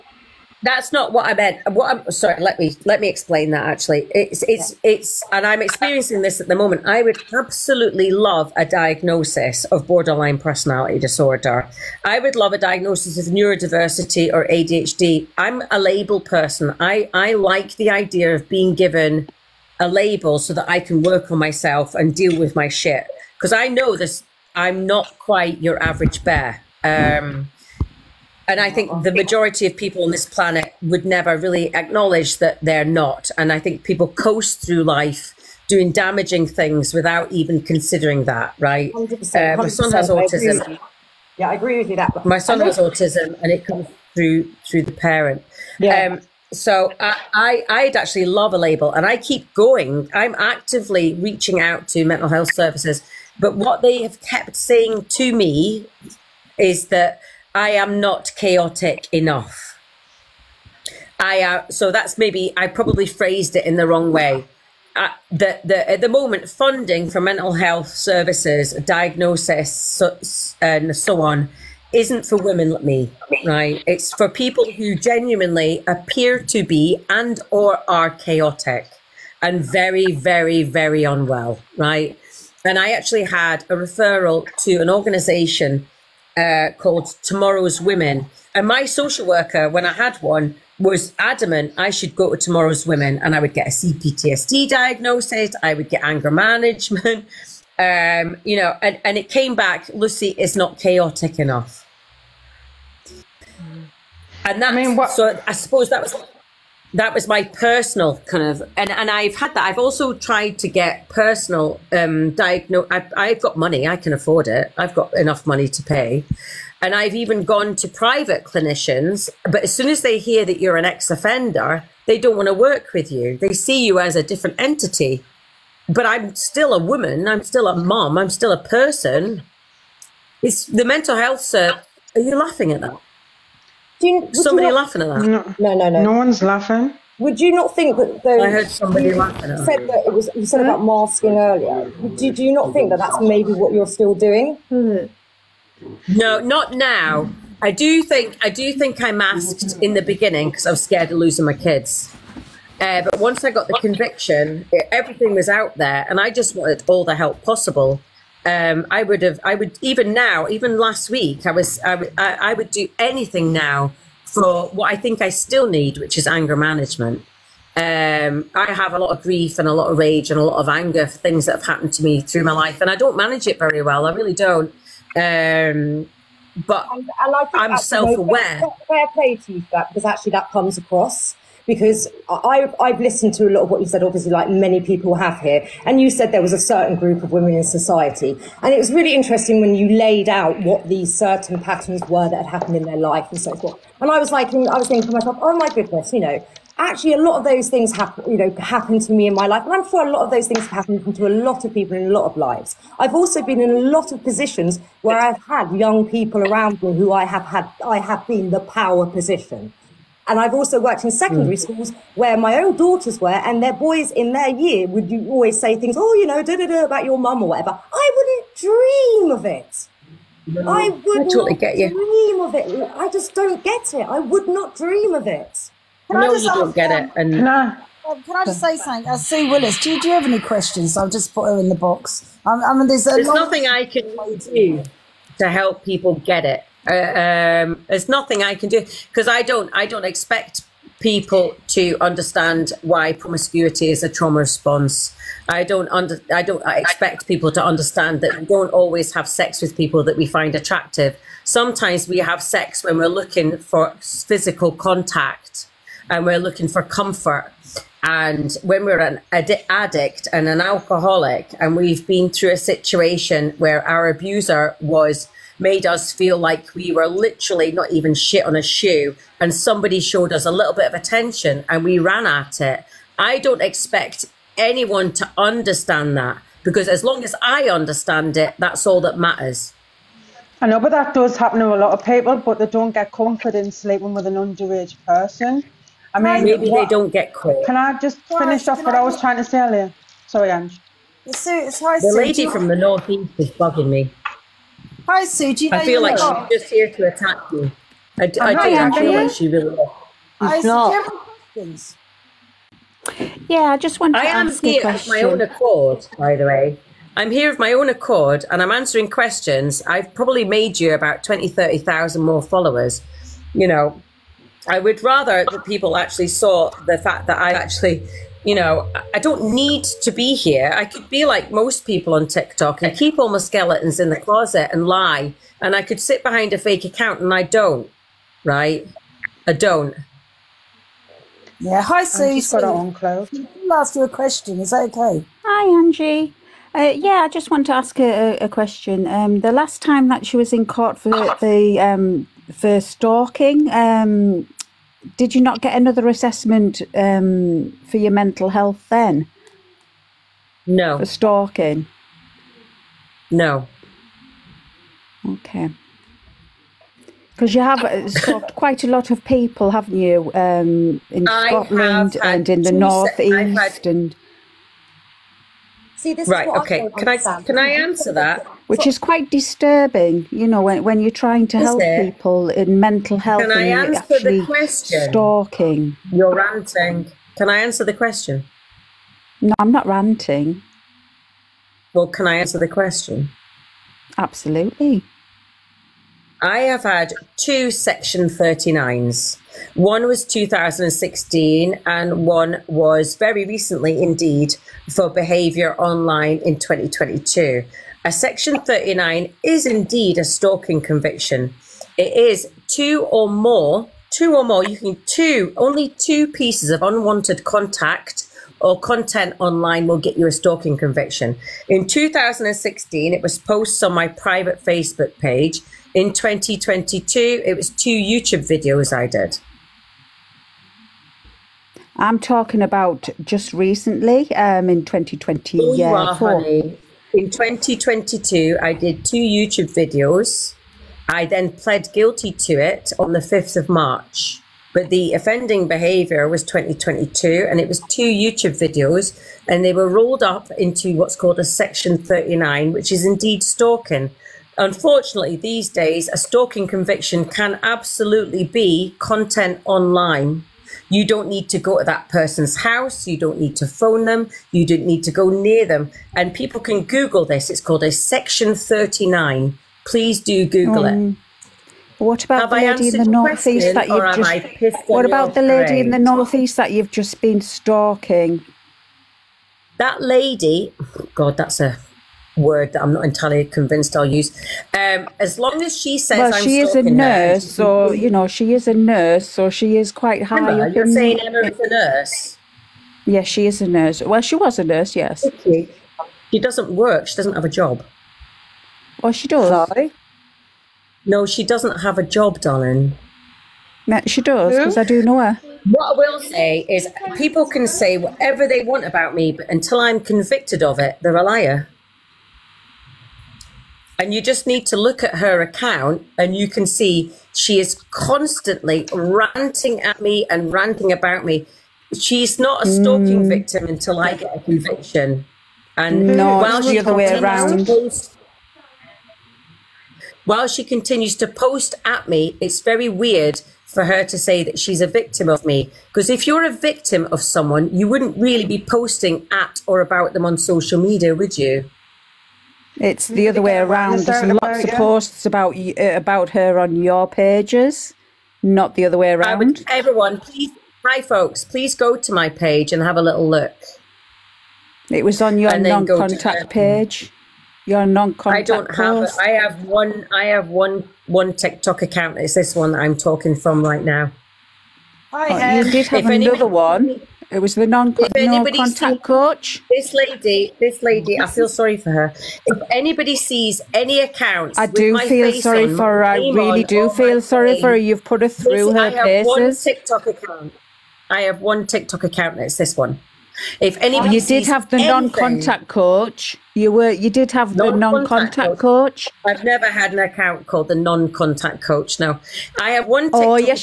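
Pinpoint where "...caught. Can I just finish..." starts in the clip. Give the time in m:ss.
4:47.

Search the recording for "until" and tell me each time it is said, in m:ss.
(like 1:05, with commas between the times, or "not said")
8:19, 8:33.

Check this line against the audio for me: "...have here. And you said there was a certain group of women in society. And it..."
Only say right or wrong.
right.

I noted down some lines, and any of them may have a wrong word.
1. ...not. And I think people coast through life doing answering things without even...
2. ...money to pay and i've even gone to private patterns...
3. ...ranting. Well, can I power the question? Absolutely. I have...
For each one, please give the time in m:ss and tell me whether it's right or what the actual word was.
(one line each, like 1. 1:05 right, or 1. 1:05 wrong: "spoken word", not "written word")
1. 0:32 wrong: "damaging", not "answering"
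2. 1:55 wrong: "clinicians", not "patterns"
3. 6:19 wrong: "answer", not "power".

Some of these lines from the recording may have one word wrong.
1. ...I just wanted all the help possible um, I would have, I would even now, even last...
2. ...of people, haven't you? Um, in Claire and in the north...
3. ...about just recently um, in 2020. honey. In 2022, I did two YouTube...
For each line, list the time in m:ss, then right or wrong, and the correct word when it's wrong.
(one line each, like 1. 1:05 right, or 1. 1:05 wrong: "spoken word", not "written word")
1. 2:36 right
2. 5:59 wrong: "Scotland", not "Claire"
3. 7:02 right.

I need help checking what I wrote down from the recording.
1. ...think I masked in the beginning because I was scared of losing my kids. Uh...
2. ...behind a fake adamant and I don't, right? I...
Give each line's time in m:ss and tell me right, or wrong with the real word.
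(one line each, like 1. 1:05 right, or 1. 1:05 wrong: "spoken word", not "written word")
1. 2:28 right
2. 5:26 wrong: "account", not "adamant".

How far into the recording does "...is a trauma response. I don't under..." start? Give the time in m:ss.
4:03.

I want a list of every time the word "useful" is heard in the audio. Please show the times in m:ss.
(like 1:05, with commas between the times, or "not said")
not said.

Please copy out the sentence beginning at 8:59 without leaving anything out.
everyone, please, hi folks, please go to my page and have a little look.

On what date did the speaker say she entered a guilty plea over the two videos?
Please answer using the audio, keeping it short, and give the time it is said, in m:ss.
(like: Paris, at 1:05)
5th of March, at 7:13.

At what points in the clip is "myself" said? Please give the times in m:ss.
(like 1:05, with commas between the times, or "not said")
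0:21, 3:15.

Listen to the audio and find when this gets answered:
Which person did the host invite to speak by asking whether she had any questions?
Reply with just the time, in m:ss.
3:49.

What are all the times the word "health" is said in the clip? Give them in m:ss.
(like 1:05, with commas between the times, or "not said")
0:52, 1:07, 2:11, 5:48, 6:13.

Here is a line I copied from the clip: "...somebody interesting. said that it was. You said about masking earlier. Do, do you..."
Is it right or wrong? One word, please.
wrong.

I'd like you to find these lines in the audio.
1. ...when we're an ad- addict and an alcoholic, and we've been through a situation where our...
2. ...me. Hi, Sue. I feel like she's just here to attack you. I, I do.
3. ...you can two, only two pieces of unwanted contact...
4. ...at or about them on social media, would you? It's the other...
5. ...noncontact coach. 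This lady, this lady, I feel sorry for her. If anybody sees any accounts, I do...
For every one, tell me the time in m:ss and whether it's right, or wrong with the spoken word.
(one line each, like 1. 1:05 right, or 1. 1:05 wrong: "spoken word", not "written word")
1. 4:18 right
2. 4:53 right
3. 6:44 right
4. 8:49 right
5. 9:17 wrong: "contact", not "noncontact".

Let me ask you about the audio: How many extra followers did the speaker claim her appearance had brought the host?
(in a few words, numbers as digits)
20,000-30,000.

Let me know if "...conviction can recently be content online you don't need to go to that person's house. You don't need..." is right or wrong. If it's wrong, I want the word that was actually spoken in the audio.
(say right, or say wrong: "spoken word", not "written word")
wrong: "absolutely", not "recently".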